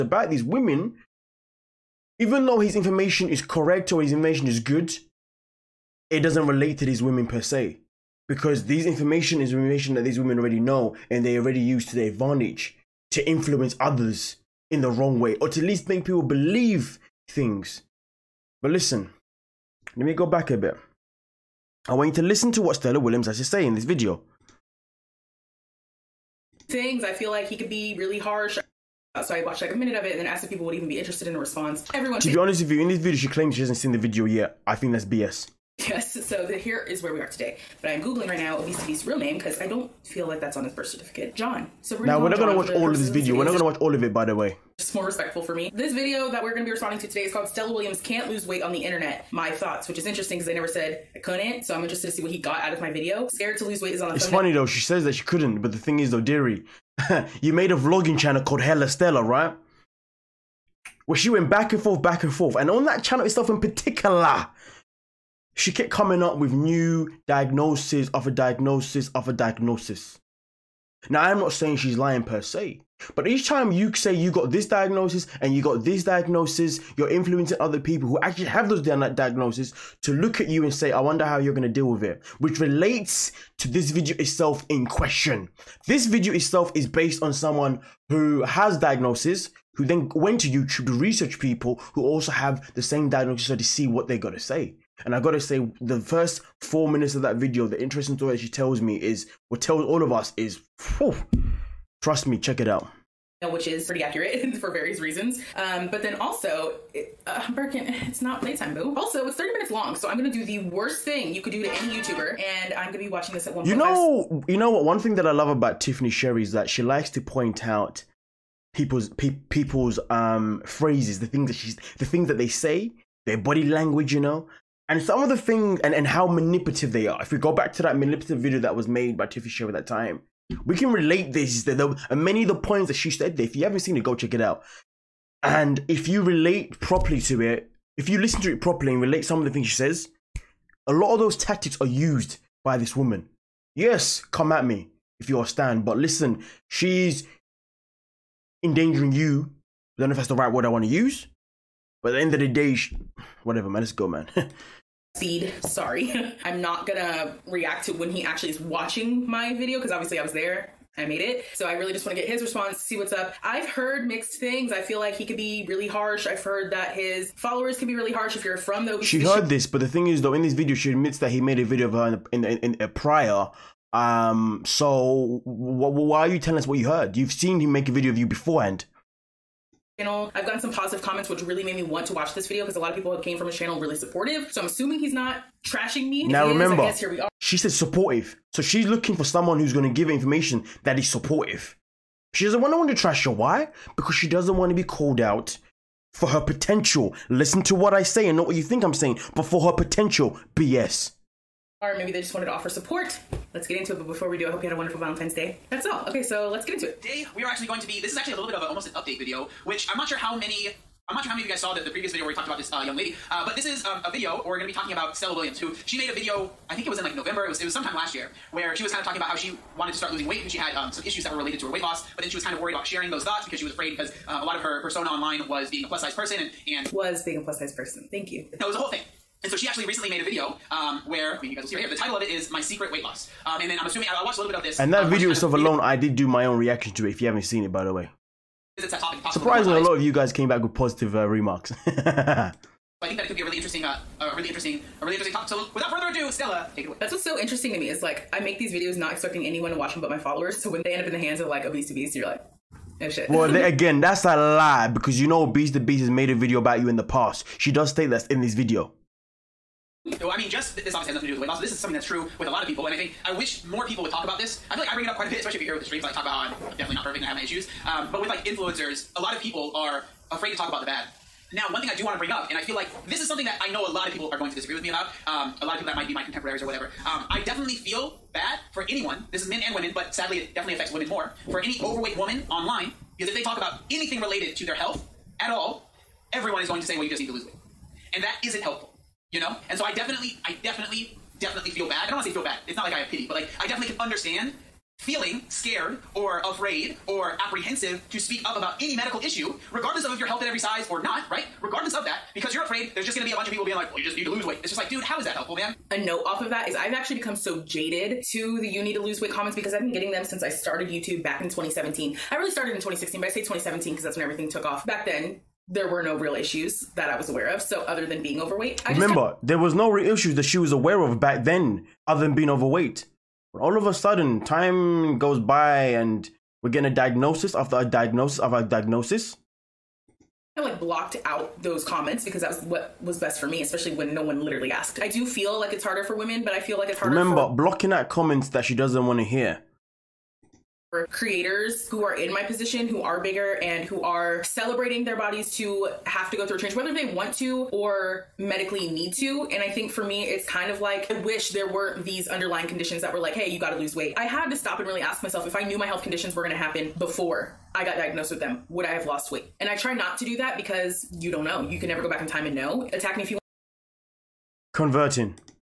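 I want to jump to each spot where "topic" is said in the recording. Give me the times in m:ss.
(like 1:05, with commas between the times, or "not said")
4:05.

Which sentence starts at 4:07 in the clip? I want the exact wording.
That's what's so interesting to me is like I make these videos not expecting anyone to watch them but my followers.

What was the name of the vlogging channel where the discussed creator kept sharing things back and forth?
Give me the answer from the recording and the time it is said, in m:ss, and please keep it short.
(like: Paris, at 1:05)
Hella Stella, at 0:58.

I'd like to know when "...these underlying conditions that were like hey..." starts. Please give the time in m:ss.
5:52.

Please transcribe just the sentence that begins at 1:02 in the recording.
And on that channel itself in particular, she kept coming up with new diagnoses of a diagnosis of a diagnosis.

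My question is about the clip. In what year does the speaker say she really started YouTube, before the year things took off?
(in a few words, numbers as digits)
2016.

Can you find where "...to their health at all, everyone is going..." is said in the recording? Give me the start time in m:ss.
4:44.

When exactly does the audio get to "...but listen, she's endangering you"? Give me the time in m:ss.
2:25.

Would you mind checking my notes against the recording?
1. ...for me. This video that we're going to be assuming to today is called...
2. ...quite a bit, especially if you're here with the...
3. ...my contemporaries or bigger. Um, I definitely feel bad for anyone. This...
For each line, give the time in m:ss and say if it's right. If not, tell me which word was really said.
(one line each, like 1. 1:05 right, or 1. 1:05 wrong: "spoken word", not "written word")
1. 0:45 wrong: "responding", not "assuming"
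2. 4:25 right
3. 4:36 wrong: "whatever", not "bigger".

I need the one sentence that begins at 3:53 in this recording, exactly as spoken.
Um, and then I'm assuming, I, I watched a little bit of this.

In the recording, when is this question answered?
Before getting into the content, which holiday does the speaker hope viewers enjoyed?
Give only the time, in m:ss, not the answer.
3:25.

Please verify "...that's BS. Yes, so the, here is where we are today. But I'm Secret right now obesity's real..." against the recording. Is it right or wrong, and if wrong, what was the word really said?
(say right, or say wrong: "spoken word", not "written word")
wrong: "Googling", not "Secret".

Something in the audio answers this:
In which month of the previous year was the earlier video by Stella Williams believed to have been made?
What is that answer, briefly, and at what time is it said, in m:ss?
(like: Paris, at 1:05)
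November, at 3:37.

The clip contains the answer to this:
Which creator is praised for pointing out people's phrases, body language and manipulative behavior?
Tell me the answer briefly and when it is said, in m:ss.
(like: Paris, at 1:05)
Tiffany Sherii, at 1:55.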